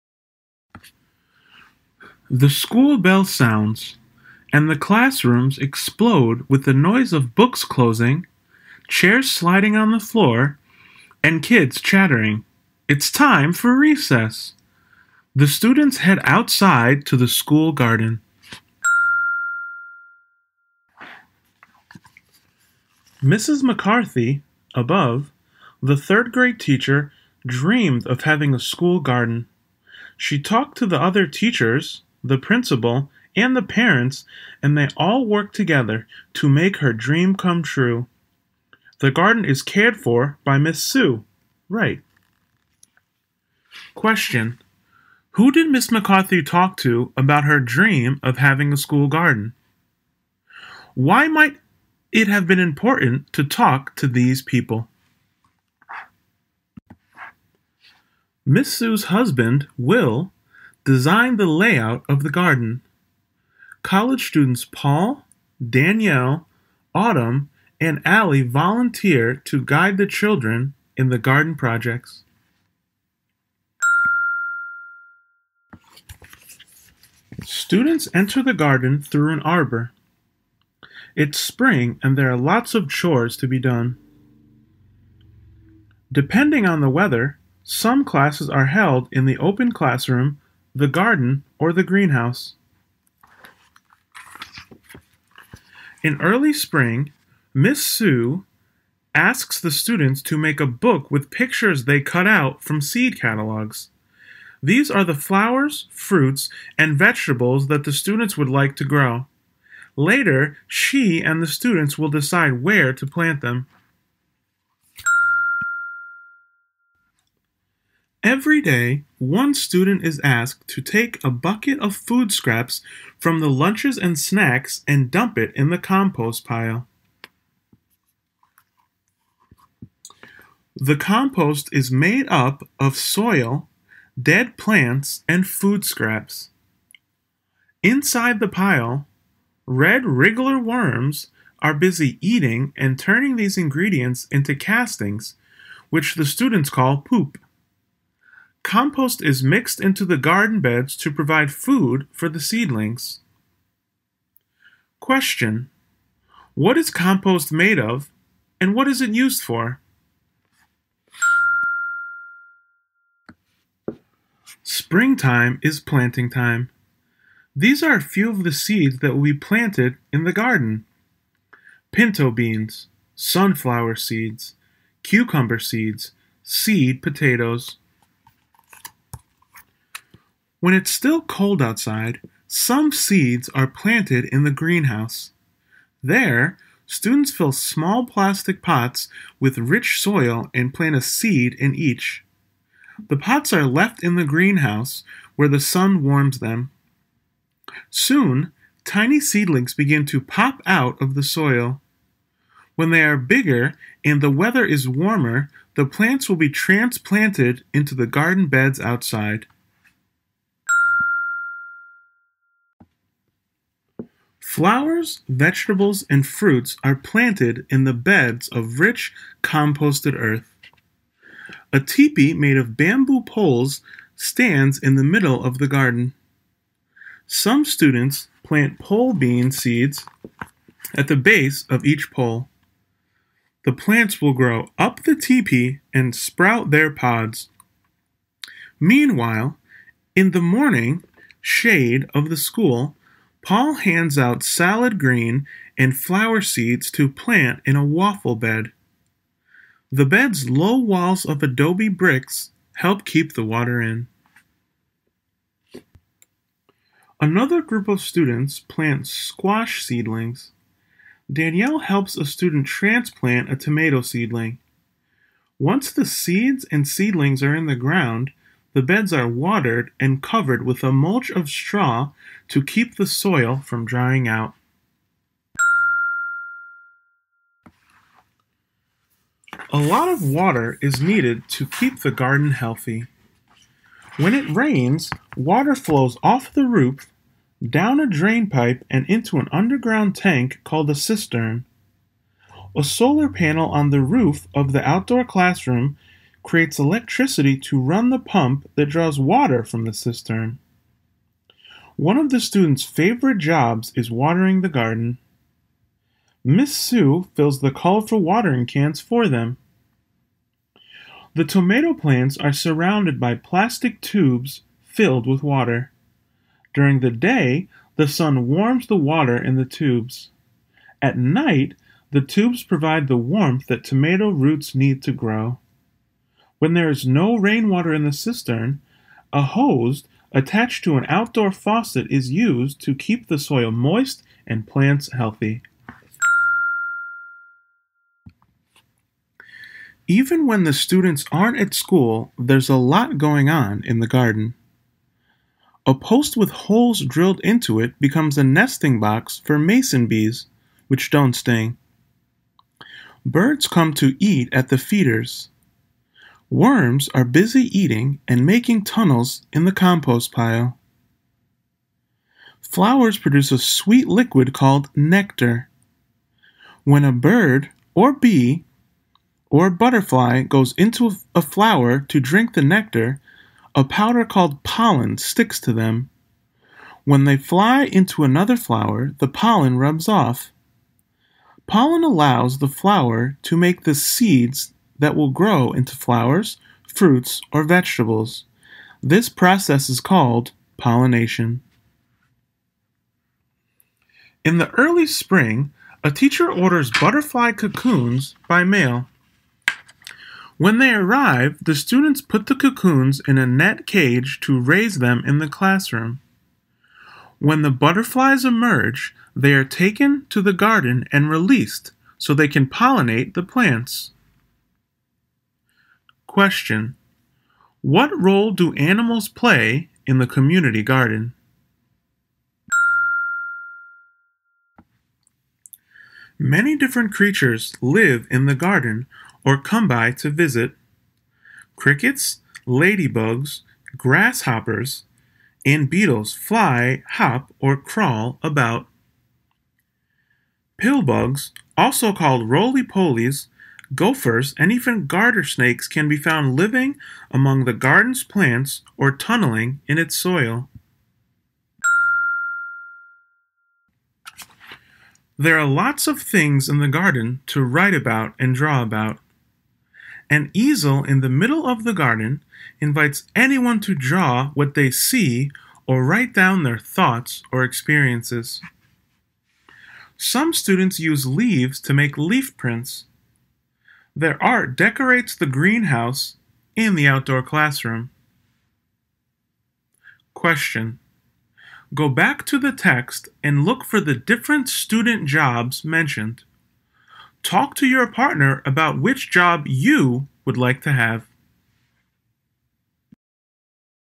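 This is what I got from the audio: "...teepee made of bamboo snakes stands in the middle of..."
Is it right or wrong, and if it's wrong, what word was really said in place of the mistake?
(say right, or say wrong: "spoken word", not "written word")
wrong: "poles", not "snakes".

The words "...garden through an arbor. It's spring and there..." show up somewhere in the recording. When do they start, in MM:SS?
01:18.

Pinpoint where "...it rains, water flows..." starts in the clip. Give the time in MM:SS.
04:44.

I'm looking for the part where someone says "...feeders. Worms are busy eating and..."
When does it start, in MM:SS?
05:54.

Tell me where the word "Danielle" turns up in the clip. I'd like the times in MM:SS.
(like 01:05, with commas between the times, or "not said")
01:05, 04:21.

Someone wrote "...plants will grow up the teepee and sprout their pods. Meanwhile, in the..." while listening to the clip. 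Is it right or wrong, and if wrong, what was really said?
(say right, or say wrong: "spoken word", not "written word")
right.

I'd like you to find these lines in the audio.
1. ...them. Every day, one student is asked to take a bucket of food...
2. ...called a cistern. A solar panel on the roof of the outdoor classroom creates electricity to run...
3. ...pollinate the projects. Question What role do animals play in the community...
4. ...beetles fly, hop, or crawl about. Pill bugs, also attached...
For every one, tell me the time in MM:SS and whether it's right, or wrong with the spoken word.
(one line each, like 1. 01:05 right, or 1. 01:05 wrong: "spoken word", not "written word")
1. 01:53 right
2. 04:50 right
3. 06:52 wrong: "plants", not "projects"
4. 07:15 wrong: "called", not "attached".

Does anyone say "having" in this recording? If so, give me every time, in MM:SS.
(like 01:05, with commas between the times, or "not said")
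00:28, 00:48.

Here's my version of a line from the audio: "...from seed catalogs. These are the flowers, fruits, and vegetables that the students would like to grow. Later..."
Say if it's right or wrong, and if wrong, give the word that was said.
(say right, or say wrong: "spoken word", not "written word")
right.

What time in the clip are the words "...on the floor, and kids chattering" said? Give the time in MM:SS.
00:09.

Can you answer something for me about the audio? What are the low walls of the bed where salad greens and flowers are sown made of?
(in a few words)
Adobe bricks.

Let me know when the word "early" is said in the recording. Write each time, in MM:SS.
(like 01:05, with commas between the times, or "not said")
01:36, 06:34.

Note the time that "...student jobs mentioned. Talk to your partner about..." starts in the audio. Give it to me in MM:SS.
08:04.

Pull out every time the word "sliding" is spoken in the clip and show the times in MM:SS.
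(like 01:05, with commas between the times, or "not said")
00:09.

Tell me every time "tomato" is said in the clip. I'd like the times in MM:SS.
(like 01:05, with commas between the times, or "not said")
04:23, 05:11, 05:23.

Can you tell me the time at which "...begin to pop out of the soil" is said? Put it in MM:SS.
03:19.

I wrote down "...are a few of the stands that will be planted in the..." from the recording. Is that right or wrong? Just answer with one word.
wrong.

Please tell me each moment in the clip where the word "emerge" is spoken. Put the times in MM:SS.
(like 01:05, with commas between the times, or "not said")
06:48.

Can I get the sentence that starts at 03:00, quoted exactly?
When it's still cold outside, some seeds are planted in the greenhouse.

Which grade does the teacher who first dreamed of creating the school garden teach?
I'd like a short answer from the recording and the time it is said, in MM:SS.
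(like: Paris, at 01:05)
Third grade, at 00:25.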